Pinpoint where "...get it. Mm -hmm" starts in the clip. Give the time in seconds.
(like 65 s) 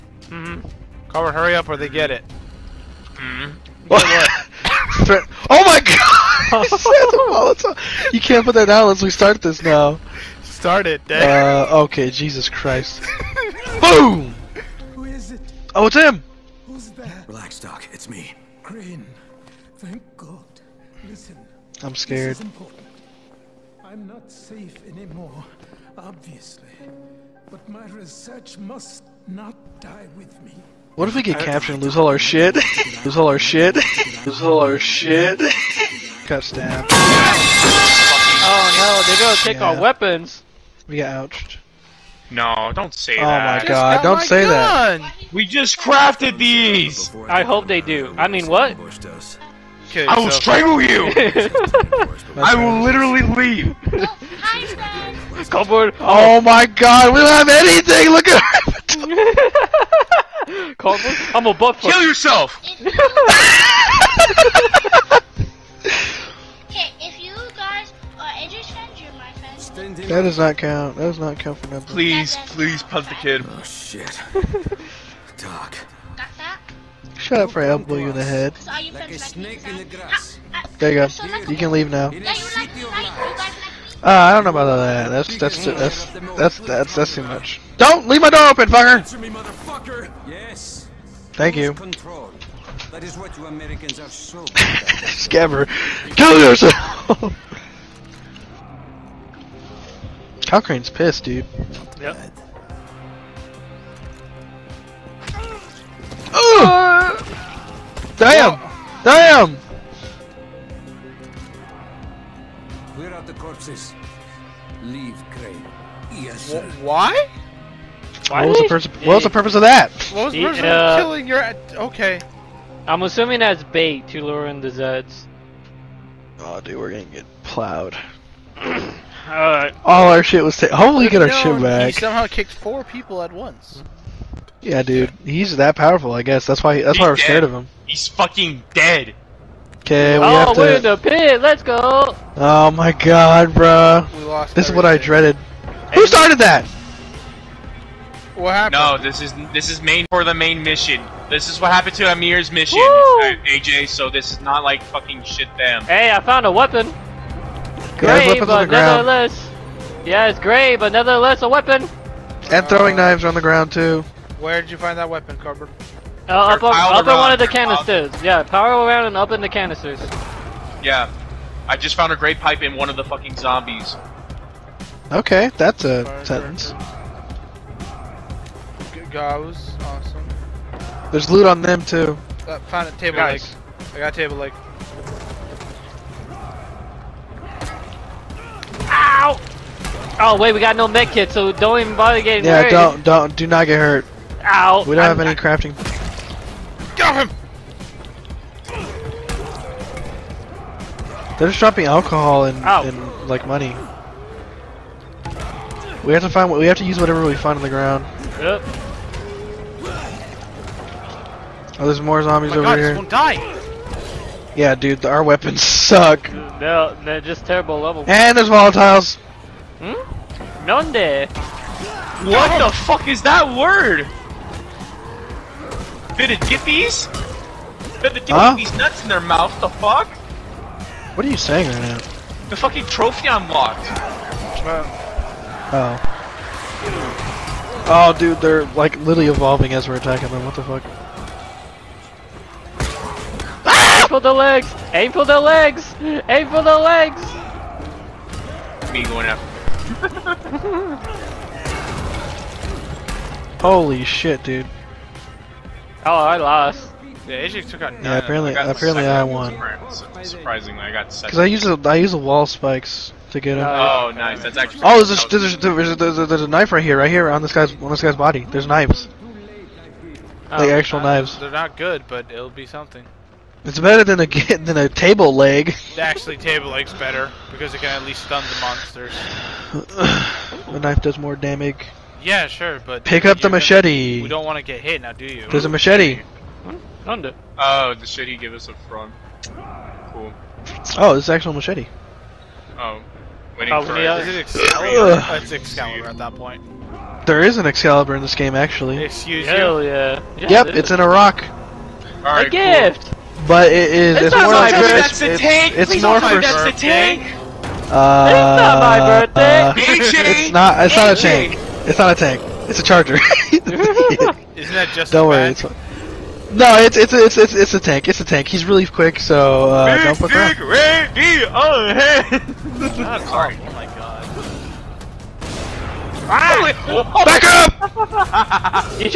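1 s.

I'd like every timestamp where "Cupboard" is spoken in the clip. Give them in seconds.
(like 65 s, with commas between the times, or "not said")
55 s, 60 s.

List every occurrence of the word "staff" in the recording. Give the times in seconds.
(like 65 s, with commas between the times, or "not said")
36 s.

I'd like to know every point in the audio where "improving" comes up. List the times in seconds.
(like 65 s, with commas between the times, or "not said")
not said.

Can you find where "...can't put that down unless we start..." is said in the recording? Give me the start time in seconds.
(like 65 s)
8 s.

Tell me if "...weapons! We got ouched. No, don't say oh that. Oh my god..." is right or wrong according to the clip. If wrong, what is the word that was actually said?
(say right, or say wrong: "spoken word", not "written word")
right.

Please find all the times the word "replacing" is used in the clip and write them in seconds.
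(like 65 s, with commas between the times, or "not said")
not said.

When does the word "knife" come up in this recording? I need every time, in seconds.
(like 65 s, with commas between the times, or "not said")
266 s, 280 s.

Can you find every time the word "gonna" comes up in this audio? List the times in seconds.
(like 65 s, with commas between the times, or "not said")
39 s, 126 s, 284 s.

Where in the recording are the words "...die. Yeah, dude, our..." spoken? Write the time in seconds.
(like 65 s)
213 s.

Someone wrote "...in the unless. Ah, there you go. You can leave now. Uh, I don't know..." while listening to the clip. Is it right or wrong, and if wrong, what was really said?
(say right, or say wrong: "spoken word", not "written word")
wrong: "grass", not "unless".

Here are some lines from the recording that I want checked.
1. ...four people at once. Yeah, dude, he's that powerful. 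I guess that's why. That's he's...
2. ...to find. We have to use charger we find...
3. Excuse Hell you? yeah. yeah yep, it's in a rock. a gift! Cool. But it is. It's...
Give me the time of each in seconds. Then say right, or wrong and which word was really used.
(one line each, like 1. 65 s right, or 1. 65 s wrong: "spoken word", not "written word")
1. 132 s right
2. 206 s wrong: "whatever", not "charger"
3. 299 s right.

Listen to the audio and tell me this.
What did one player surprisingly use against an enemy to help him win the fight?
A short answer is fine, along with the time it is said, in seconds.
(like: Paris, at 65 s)
The wall spikes, at 262 s.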